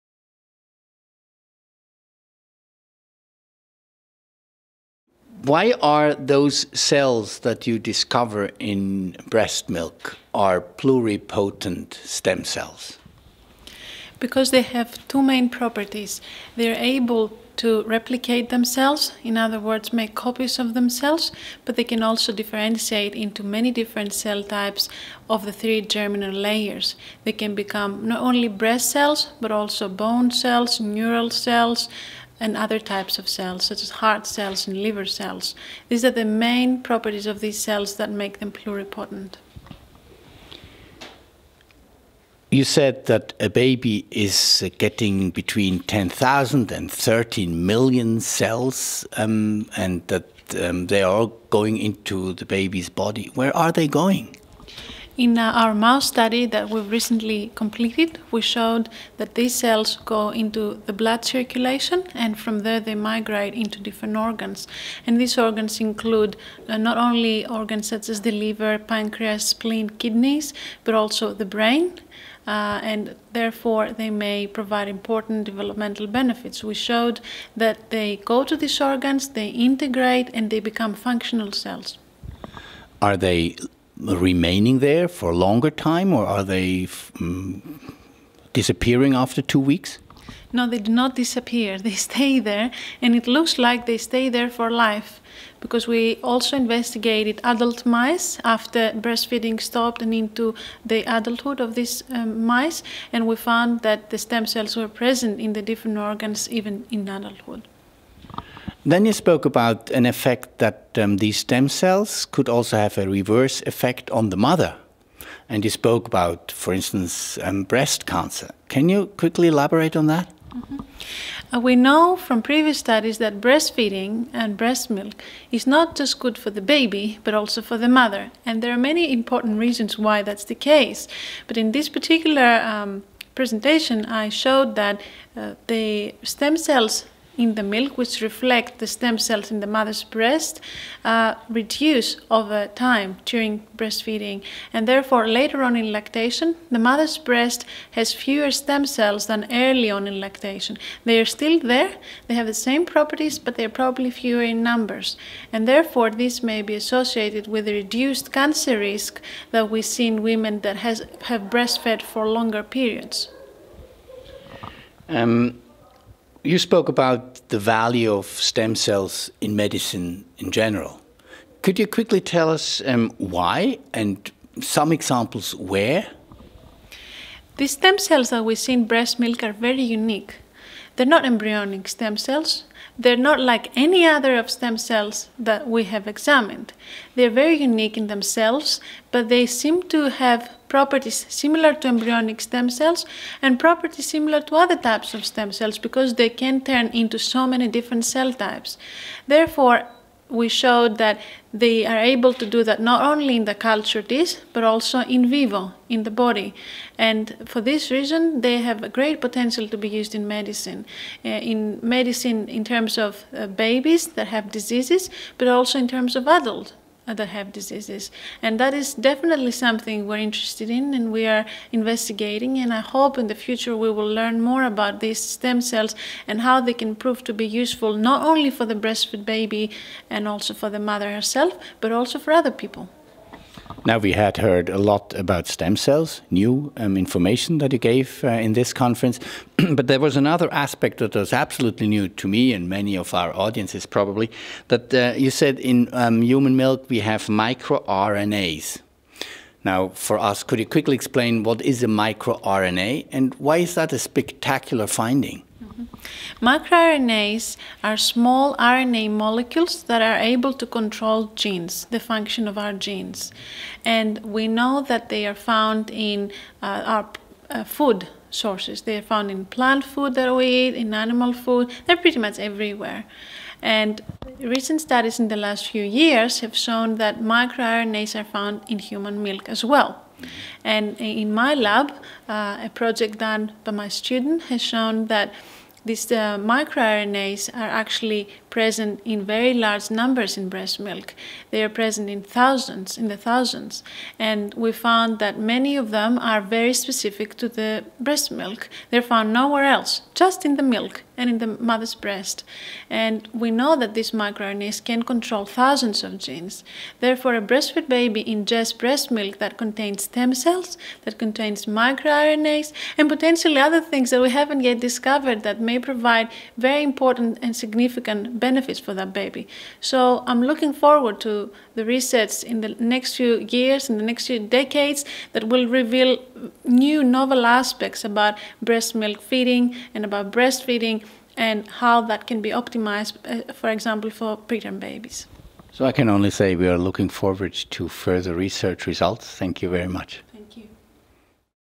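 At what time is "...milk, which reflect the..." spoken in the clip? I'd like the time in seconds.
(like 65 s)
137 s.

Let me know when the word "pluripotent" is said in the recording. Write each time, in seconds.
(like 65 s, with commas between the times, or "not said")
10 s, 38 s.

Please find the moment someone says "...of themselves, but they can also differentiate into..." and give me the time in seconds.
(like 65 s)
20 s.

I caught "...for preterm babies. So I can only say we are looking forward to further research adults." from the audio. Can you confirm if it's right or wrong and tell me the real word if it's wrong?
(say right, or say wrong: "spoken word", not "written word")
wrong: "results", not "adults".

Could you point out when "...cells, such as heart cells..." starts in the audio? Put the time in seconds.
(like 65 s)
33 s.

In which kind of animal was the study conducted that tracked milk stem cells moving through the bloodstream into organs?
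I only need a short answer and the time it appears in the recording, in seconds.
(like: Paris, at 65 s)
mouse, at 55 s.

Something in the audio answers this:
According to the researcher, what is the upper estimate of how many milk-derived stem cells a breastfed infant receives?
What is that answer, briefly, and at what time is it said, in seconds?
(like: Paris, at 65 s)
13 million, at 46 s.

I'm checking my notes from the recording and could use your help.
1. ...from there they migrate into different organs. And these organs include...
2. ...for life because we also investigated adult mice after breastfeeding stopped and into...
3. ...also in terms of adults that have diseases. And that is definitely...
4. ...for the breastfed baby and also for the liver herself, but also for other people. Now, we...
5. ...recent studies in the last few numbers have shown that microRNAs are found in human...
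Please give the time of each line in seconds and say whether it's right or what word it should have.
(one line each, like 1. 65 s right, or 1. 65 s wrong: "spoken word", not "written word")
1. 62 s right
2. 94 s right
3. 215 s right
4. 228 s wrong: "mother", not "liver"
5. 274 s wrong: "years", not "numbers".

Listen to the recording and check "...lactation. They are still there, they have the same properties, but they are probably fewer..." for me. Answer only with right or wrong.
right.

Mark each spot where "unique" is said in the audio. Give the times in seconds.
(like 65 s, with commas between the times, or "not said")
179 s, 187 s.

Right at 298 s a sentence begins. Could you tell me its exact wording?
They're found nowhere else, just in the milk and in the mother's breast.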